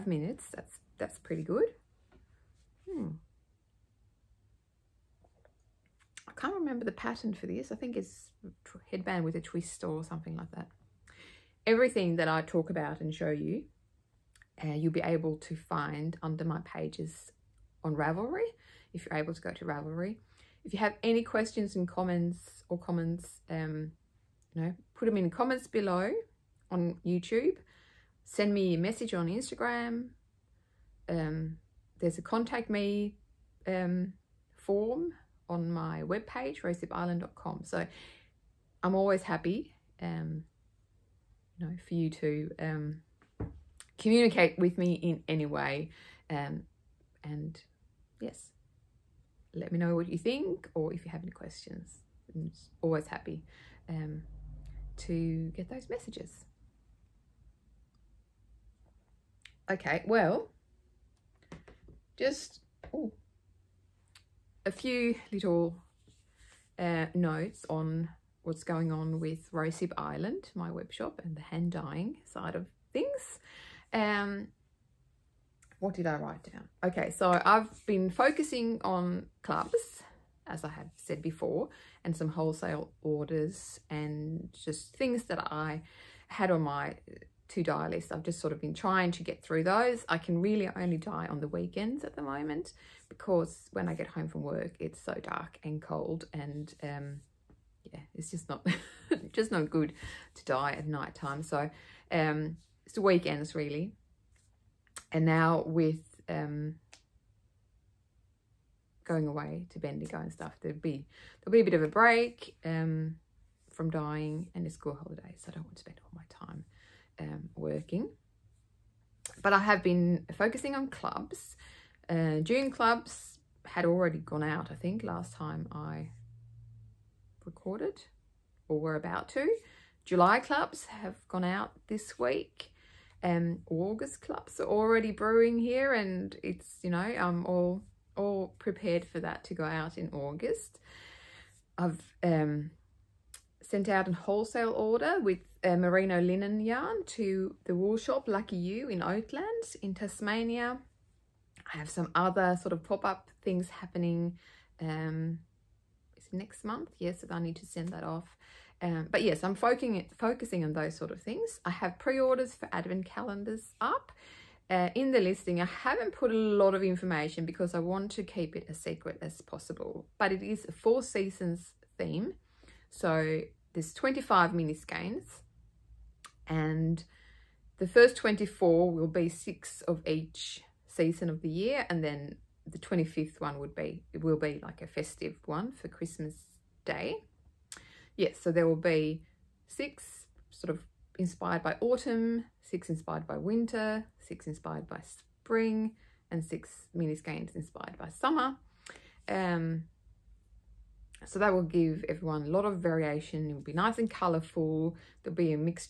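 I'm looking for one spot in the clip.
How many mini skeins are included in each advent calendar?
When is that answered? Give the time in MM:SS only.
02:53.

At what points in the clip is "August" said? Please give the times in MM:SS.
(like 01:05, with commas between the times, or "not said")
02:13, 02:20.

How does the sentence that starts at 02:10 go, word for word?
July clubs have gone out this week.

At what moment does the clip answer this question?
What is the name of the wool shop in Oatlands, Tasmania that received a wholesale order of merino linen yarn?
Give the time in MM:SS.
02:28.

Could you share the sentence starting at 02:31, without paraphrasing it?
I have some other sort of pop-up things happening um, next month.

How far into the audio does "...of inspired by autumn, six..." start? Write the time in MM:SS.
03:10.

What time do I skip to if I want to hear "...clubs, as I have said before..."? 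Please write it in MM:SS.
01:19.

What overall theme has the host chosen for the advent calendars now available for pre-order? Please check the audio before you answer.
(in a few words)
Four Seasons.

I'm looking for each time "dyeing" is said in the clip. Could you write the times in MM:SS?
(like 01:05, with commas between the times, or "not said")
01:11, 01:53.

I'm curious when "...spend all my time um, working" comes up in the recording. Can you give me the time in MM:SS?
01:55.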